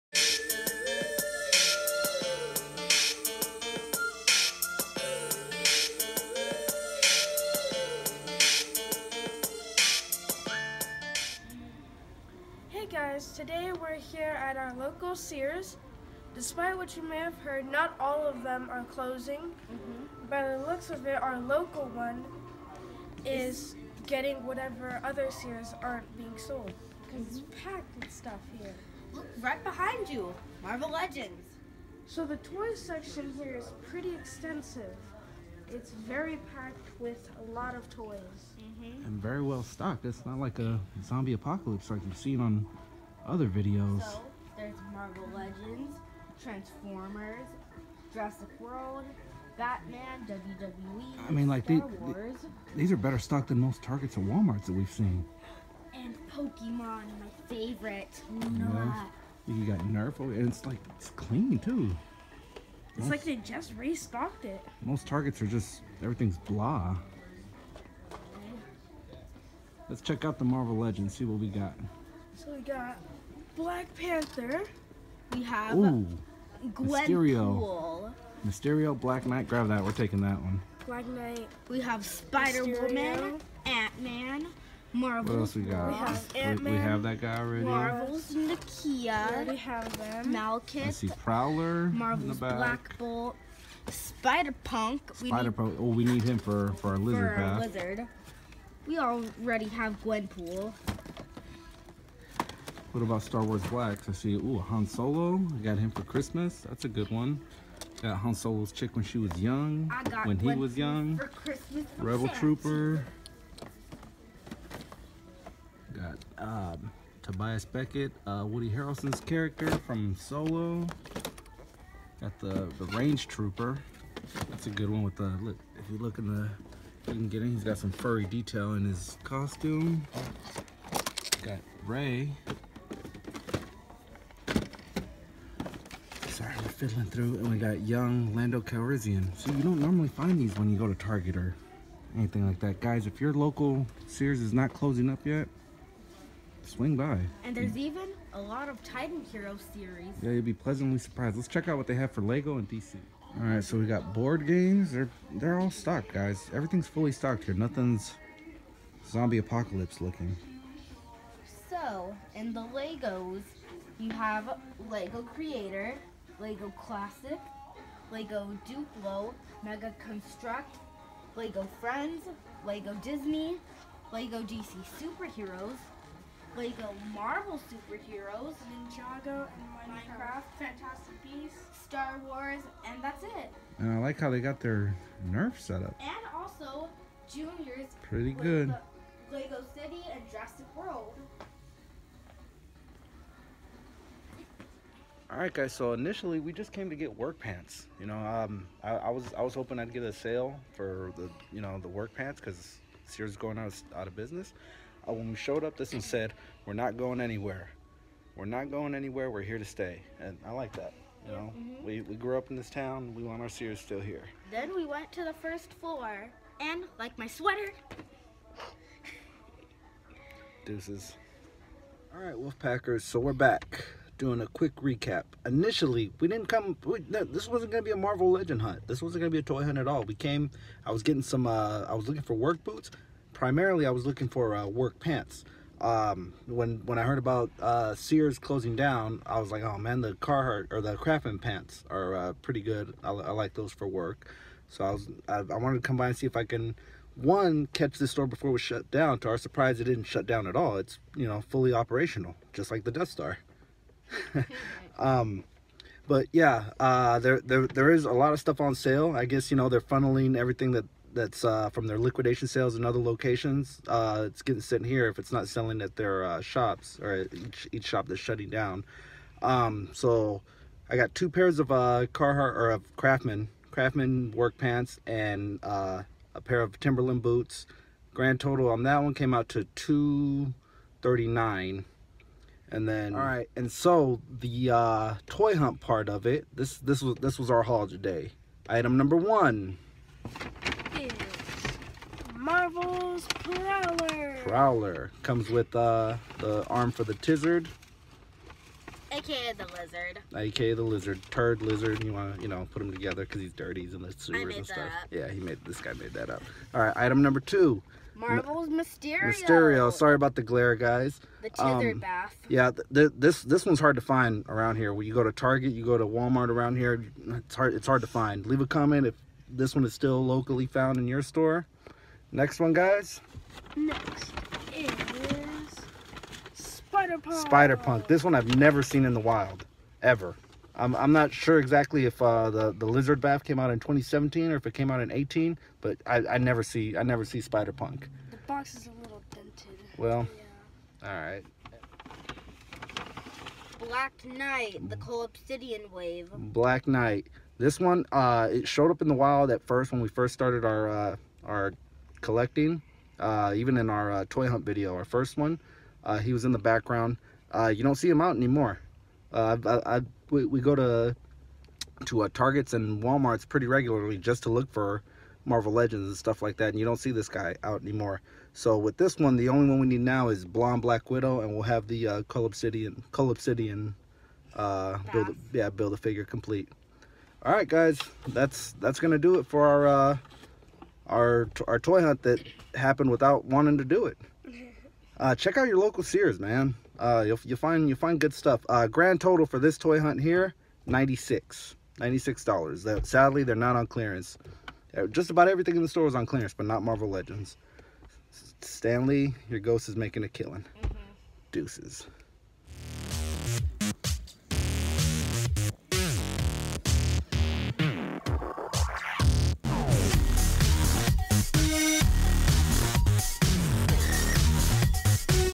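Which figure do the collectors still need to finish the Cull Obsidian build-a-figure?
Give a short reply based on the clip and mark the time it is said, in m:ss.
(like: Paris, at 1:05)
Blonde Black Widow, at 6:10.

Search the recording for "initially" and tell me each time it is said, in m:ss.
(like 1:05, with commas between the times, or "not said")
3:15, 3:45.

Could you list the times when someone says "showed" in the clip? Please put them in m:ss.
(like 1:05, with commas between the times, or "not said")
3:25, 5:48.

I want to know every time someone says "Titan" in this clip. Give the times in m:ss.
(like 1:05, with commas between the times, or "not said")
2:28.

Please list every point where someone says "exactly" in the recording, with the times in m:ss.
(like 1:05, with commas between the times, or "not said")
5:31.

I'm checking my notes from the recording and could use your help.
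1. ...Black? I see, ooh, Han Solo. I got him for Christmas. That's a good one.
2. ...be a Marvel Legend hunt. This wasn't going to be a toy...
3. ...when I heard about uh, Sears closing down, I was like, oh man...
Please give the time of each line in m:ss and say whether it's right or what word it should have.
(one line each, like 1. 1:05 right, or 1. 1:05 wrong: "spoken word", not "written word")
1. 1:43 right
2. 3:47 right
3. 3:56 right.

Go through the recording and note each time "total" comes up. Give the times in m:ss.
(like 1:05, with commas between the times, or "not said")
4:38, 6:29.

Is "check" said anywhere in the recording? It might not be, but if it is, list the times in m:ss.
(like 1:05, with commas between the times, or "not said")
1:10, 2:31, 6:25.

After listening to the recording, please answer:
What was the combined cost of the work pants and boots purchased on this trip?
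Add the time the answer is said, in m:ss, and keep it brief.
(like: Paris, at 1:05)
$239, at 4:39.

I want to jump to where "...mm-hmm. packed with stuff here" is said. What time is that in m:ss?
0:27.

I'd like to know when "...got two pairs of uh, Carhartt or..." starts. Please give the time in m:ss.
4:30.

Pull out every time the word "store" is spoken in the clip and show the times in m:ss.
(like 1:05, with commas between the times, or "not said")
4:08, 5:21, 6:35.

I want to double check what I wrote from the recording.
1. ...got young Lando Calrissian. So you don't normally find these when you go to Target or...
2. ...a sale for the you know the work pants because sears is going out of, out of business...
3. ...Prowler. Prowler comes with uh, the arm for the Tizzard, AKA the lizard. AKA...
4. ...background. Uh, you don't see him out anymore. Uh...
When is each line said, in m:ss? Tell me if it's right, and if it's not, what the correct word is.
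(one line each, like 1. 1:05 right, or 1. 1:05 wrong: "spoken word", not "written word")
1. 2:17 right
2. 3:20 right
3. 4:53 right
4. 5:56 right.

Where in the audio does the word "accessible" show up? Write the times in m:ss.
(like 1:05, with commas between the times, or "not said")
not said.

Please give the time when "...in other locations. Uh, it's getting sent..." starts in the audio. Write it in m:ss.
4:22.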